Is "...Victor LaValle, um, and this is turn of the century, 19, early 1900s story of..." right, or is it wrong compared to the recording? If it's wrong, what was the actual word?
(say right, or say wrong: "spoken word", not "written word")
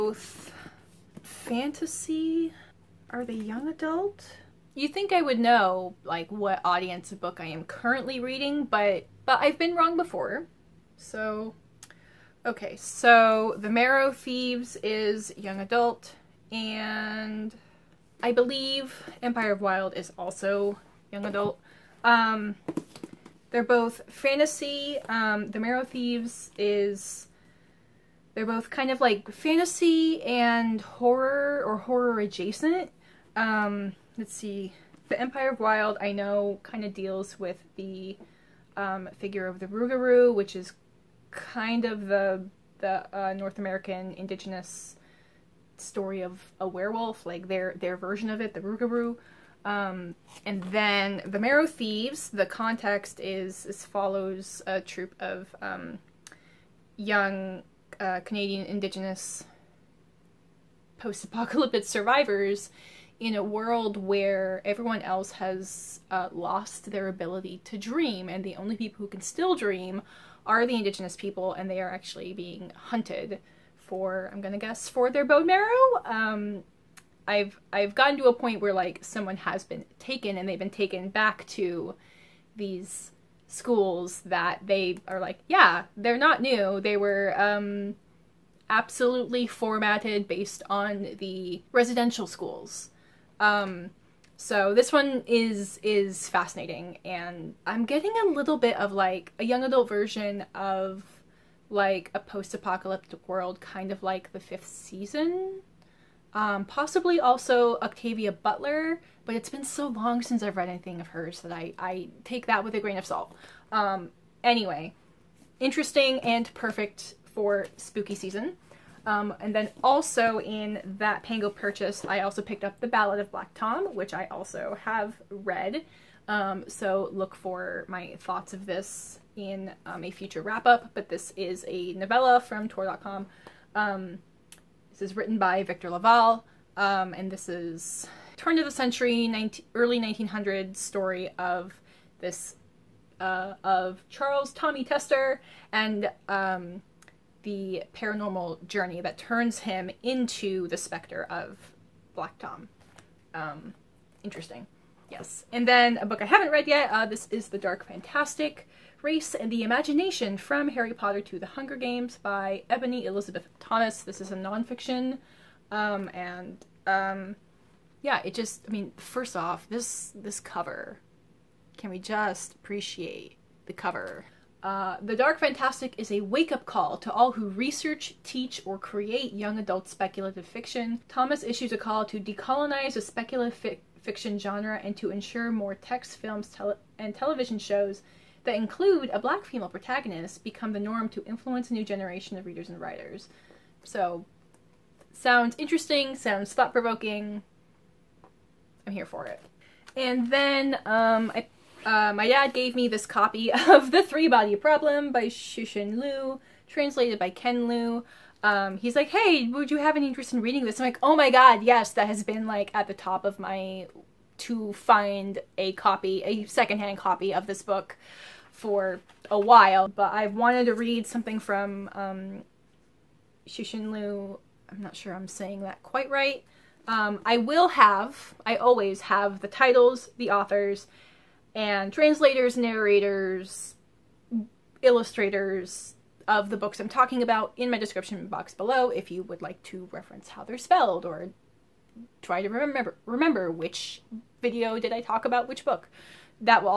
right.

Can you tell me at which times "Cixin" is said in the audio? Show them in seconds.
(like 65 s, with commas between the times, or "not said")
205 s, 223 s.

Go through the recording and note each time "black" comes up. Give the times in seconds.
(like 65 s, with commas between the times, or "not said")
123 s, 152 s, 189 s.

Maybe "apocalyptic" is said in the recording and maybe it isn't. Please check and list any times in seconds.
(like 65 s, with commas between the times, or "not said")
60 s, 102 s.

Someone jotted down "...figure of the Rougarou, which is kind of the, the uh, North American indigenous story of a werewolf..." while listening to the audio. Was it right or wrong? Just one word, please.
right.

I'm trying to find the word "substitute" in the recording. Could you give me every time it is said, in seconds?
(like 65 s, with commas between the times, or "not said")
not said.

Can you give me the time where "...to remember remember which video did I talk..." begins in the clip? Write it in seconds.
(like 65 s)
242 s.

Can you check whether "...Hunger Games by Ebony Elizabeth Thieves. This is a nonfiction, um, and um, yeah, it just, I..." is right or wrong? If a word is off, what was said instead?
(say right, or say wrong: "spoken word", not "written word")
wrong: "Thomas", not "Thieves".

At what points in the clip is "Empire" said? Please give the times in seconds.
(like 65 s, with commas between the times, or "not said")
19 s, 35 s.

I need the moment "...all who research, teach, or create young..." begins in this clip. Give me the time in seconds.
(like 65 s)
177 s.